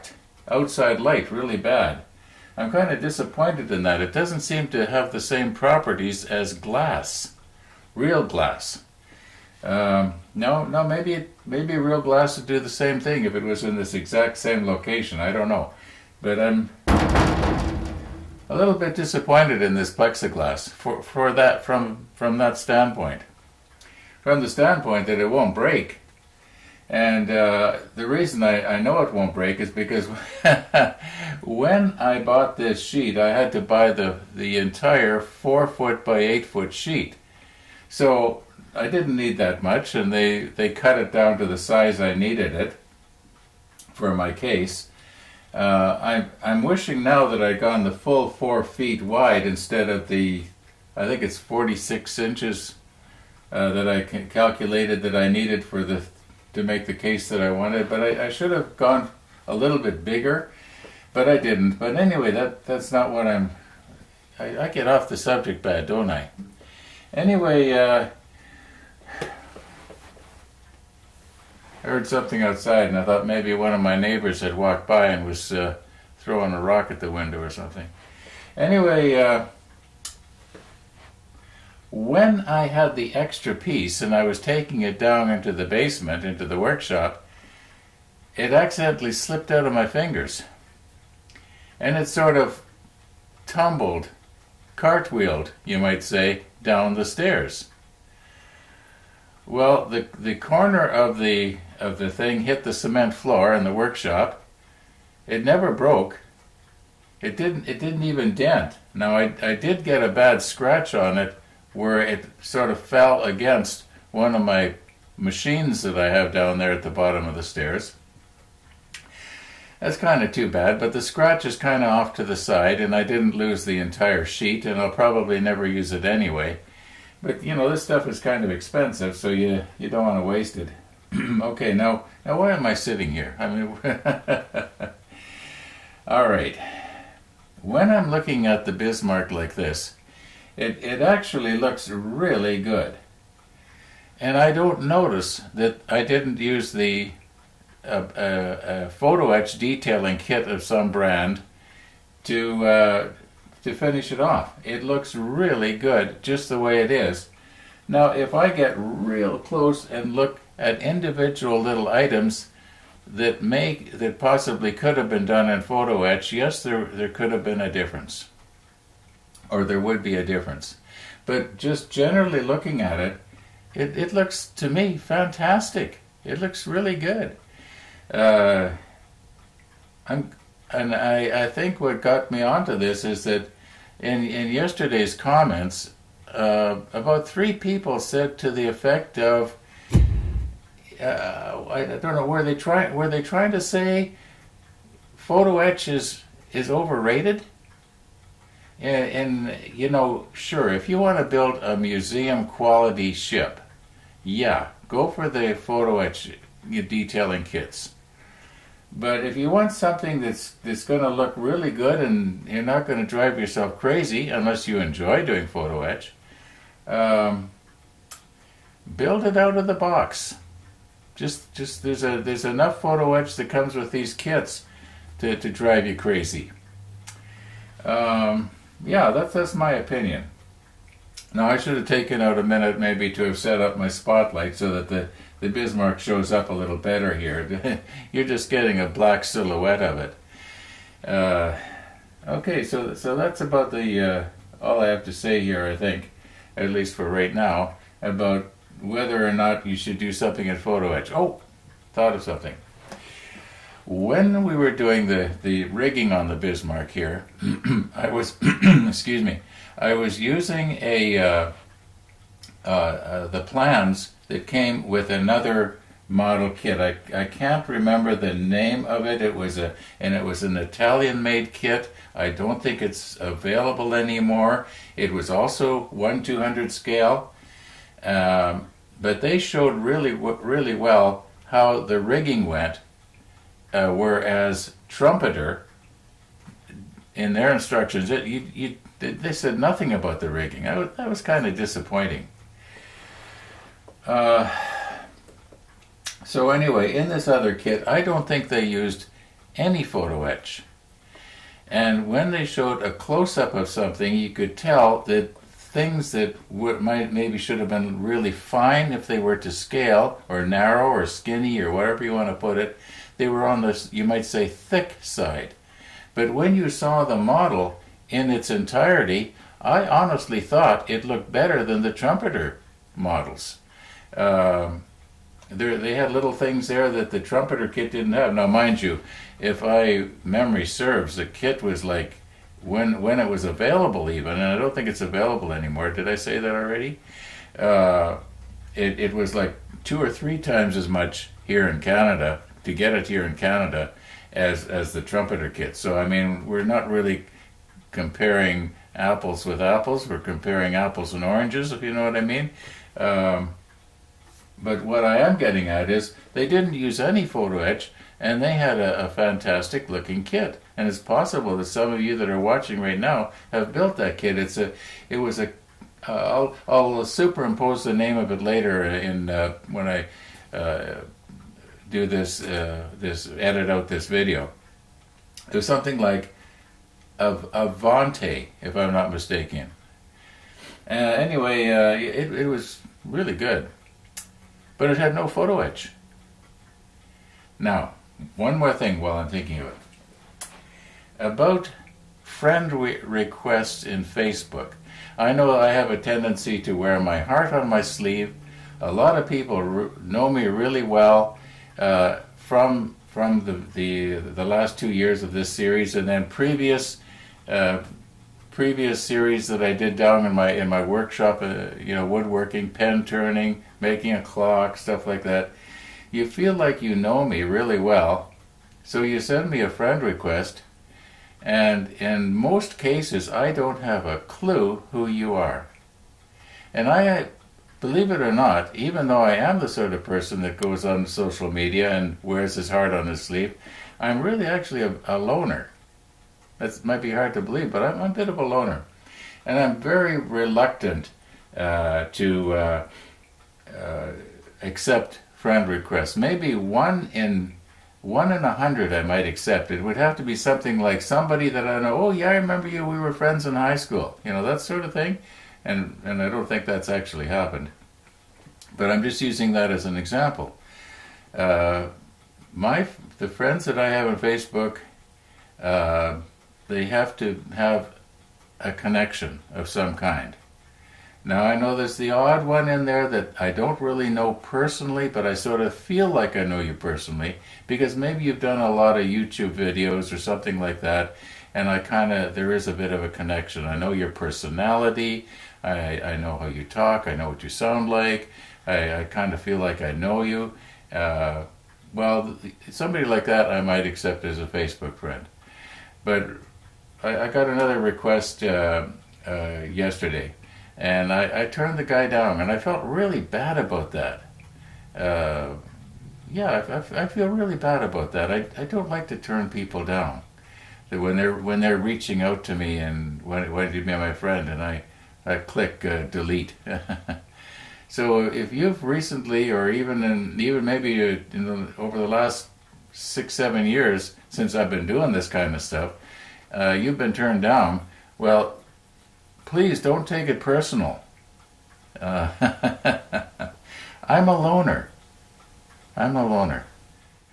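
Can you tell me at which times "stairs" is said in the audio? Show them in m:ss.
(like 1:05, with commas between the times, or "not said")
1:37, 1:57.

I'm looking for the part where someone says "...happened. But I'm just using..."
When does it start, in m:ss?
7:37.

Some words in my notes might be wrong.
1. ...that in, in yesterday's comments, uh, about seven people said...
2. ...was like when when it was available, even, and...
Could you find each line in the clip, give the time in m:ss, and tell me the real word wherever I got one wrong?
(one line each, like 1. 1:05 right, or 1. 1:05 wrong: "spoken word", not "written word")
1. 3:03 wrong: "three", not "seven"
2. 5:31 right.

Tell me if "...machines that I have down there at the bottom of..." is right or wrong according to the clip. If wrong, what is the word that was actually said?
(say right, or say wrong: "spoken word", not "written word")
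right.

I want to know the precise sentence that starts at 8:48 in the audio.
Well, please don't take it personal.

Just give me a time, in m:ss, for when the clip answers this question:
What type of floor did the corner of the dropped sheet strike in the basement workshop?
1:42.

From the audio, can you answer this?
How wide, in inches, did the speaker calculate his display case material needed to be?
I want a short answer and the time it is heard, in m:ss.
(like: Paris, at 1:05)
46 inches, at 0:51.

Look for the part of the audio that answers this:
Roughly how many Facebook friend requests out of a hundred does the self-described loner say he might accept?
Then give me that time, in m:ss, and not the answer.
7:28.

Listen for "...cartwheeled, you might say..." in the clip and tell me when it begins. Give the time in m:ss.
1:34.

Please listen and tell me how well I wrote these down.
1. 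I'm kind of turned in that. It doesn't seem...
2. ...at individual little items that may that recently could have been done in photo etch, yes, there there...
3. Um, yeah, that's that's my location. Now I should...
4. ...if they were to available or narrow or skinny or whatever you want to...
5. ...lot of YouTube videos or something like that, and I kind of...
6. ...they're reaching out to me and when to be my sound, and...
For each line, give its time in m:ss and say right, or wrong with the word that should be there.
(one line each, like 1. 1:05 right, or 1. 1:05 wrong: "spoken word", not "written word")
1. 0:02 wrong: "disappointed", not "turned"
2. 2:40 wrong: "possibly", not "recently"
3. 3:47 wrong: "opinion", not "location"
4. 5:08 wrong: "scale", not "available"
5. 7:58 right
6. 8:31 wrong: "friend", not "sound".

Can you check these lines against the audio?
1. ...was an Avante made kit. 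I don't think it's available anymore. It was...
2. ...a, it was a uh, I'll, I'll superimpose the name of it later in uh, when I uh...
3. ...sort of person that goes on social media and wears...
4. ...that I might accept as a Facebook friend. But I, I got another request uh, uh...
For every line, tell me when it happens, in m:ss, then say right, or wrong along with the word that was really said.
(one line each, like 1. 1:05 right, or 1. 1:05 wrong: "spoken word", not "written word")
1. 4:30 wrong: "Italian", not "Avante"
2. 6:04 right
3. 7:09 right
4. 8:13 right.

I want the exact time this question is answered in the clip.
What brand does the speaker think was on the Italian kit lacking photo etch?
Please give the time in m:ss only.
6:17.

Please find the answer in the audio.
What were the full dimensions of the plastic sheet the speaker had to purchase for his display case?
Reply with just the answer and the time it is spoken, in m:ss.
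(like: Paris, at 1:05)
4 foot by 8 foot, at 0:35.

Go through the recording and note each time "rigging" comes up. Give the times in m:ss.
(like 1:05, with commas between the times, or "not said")
4:15, 4:41, 4:50.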